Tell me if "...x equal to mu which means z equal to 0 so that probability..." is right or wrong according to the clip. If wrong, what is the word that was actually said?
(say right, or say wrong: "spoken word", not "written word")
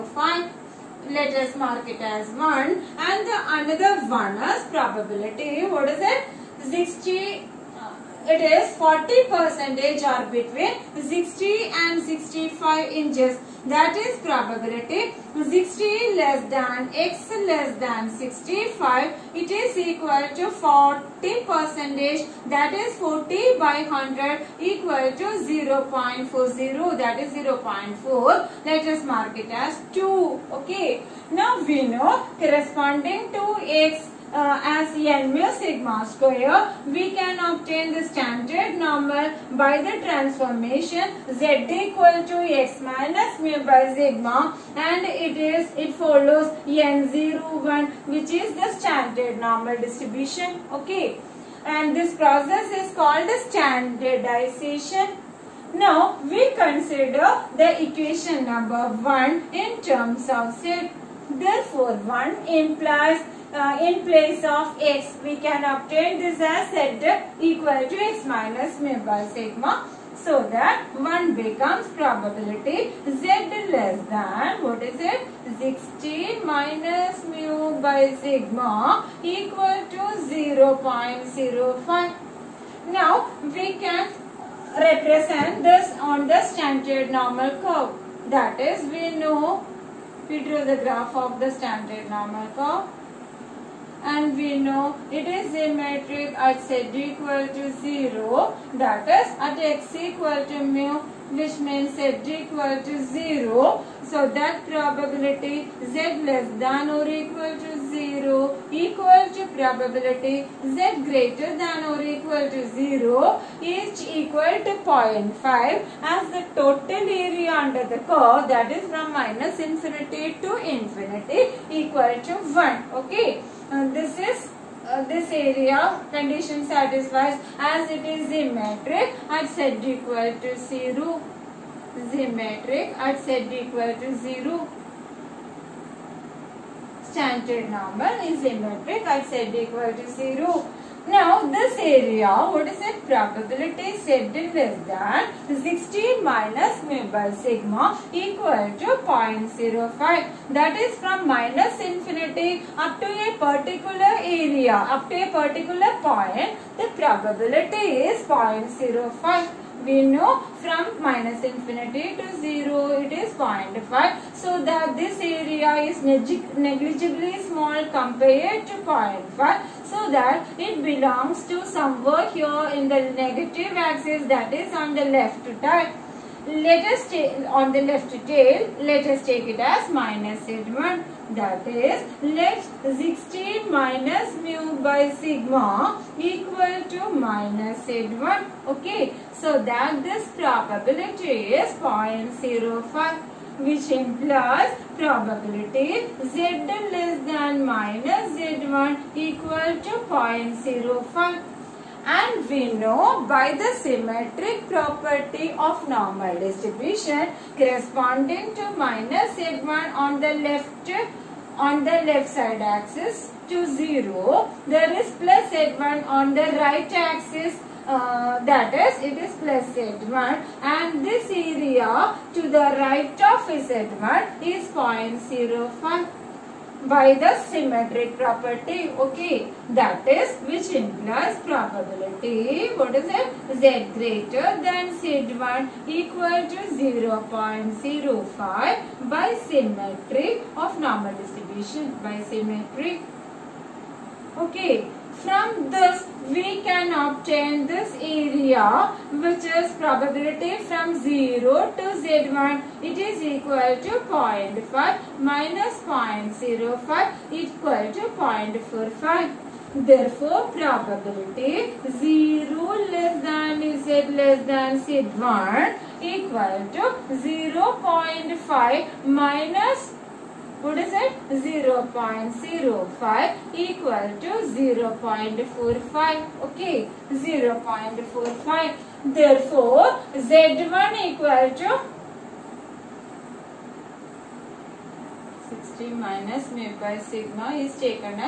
right.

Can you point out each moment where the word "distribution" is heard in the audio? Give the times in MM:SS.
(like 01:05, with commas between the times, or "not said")
00:49, 03:26, 04:01.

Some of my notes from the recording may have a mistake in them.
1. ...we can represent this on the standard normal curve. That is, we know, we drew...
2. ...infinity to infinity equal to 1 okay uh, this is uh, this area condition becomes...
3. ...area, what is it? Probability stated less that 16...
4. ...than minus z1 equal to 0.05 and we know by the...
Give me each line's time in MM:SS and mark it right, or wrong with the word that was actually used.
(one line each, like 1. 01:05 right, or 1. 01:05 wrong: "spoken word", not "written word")
1. 01:23 right
2. 01:59 wrong: "satisfies", not "becomes"
3. 02:21 right
4. 03:17 right.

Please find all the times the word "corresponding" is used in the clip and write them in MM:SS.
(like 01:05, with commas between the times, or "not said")
00:32, 03:27.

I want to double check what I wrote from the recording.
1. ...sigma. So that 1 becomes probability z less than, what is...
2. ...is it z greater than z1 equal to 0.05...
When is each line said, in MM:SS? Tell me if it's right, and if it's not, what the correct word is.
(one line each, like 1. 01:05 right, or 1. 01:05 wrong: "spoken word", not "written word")
1. 01:09 right
2. 03:52 right.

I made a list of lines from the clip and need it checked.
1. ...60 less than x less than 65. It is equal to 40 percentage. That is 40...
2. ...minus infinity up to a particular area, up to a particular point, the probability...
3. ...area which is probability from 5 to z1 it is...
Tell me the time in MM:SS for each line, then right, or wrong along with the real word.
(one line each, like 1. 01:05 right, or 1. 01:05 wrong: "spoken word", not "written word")
1. 00:15 right
2. 02:31 right
3. 04:07 wrong: "0", not "5".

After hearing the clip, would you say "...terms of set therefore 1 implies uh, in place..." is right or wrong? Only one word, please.
right.